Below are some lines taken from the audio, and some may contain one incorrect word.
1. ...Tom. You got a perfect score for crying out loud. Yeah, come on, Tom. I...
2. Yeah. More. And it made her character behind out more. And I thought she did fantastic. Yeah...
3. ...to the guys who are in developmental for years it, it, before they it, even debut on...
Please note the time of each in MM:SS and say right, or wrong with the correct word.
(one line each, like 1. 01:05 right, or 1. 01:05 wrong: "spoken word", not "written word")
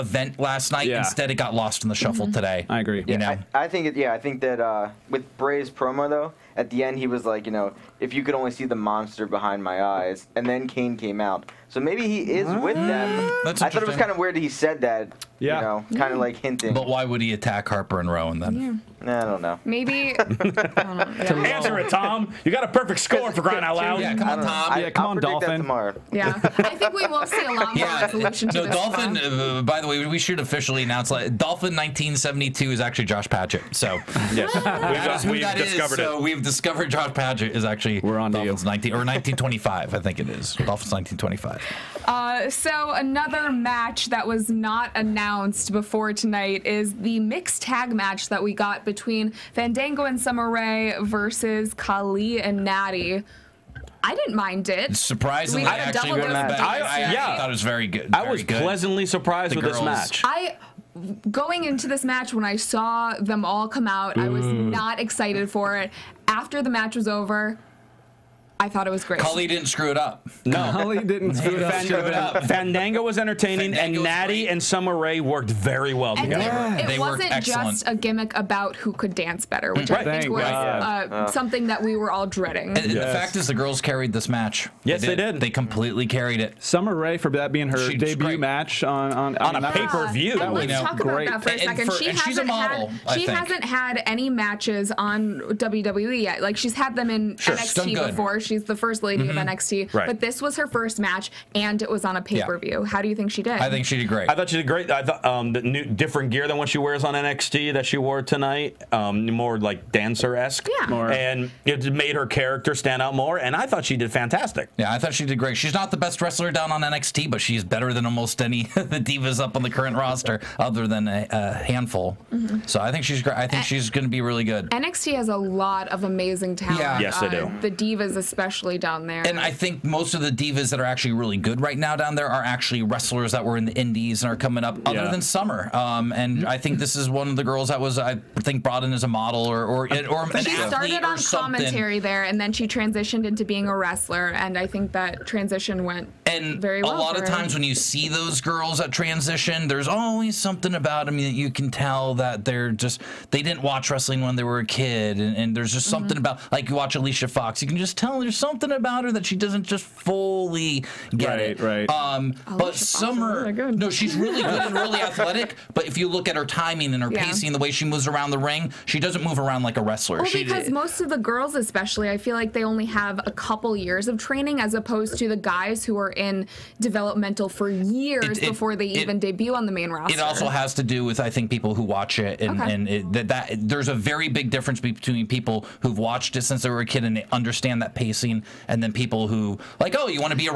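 1. 00:21 right
2. 01:50 wrong: "stand", not "behind"
3. 02:55 right.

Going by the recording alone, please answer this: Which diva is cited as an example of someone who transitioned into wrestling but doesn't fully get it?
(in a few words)
Alicia Fox.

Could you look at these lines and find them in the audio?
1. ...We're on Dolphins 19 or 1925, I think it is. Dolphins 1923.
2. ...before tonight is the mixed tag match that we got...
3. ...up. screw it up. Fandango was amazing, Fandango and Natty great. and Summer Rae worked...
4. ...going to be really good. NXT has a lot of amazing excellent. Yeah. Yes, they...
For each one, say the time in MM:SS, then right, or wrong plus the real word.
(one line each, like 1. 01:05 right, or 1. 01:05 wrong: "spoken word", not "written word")
1. 00:37 wrong: "1925", not "1923"
2. 00:45 right
3. 01:11 wrong: "entertaining", not "amazing"
4. 02:03 wrong: "talent", not "excellent".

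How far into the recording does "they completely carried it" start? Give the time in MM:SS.
01:25.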